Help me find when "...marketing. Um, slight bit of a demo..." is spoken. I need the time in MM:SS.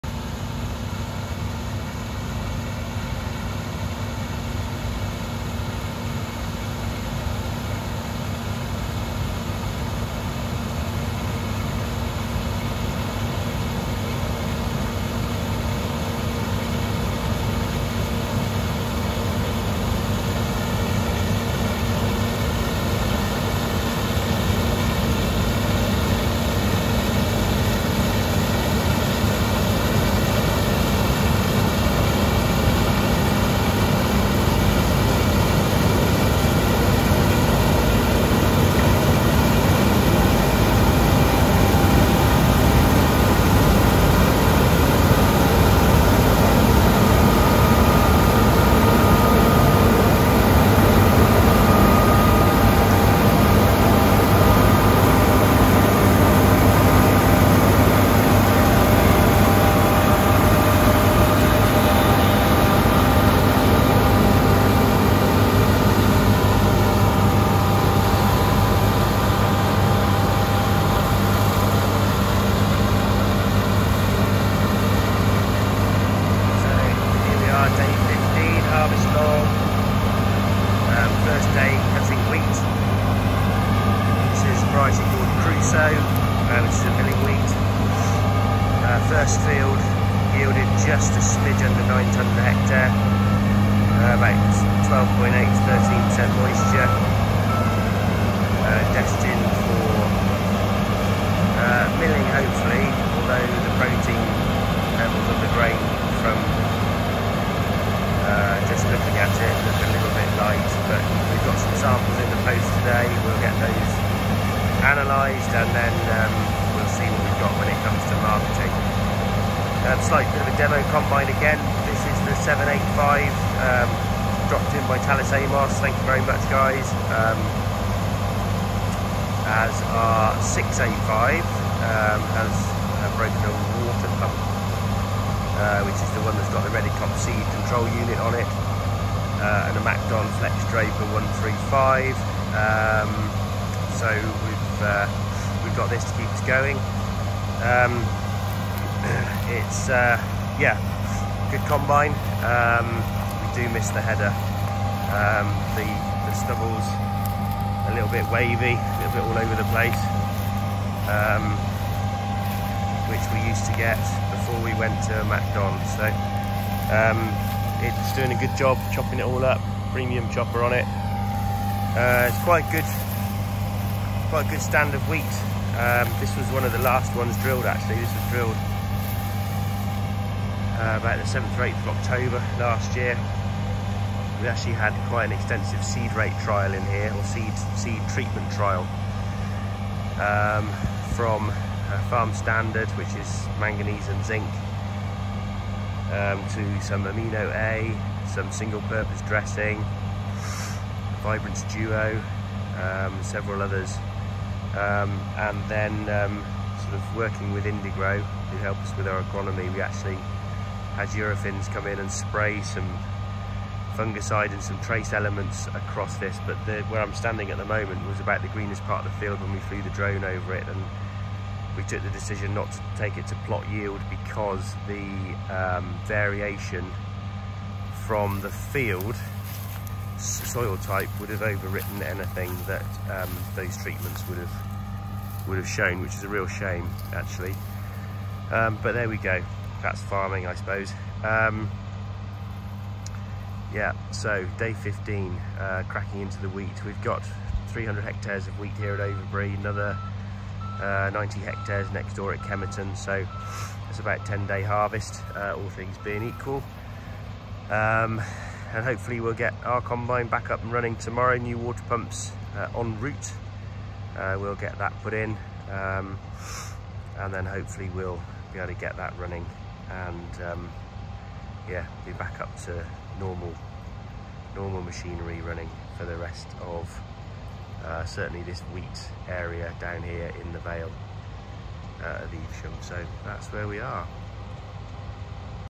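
01:58.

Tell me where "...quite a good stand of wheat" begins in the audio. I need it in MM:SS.
02:54.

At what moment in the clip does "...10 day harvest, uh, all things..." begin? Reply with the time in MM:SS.
04:14.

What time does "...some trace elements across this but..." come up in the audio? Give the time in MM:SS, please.
03:34.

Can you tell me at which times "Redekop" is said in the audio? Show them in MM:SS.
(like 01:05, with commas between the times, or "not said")
02:16.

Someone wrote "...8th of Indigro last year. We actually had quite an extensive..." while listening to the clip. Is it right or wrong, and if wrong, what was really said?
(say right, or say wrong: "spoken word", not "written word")
wrong: "October", not "Indigro".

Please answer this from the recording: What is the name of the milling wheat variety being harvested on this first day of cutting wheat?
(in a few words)
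Crusoe.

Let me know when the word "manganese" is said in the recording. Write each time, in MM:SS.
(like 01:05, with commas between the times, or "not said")
03:13.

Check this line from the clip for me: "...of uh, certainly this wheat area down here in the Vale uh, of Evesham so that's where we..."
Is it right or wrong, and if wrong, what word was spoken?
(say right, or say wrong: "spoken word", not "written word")
right.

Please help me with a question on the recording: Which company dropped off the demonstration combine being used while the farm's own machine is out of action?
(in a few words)
Tallis Amos.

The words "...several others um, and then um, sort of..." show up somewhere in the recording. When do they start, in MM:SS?
03:23.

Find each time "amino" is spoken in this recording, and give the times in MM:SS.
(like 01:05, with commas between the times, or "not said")
03:17.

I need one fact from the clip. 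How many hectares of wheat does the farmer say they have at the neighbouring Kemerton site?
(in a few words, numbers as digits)
90 hectares.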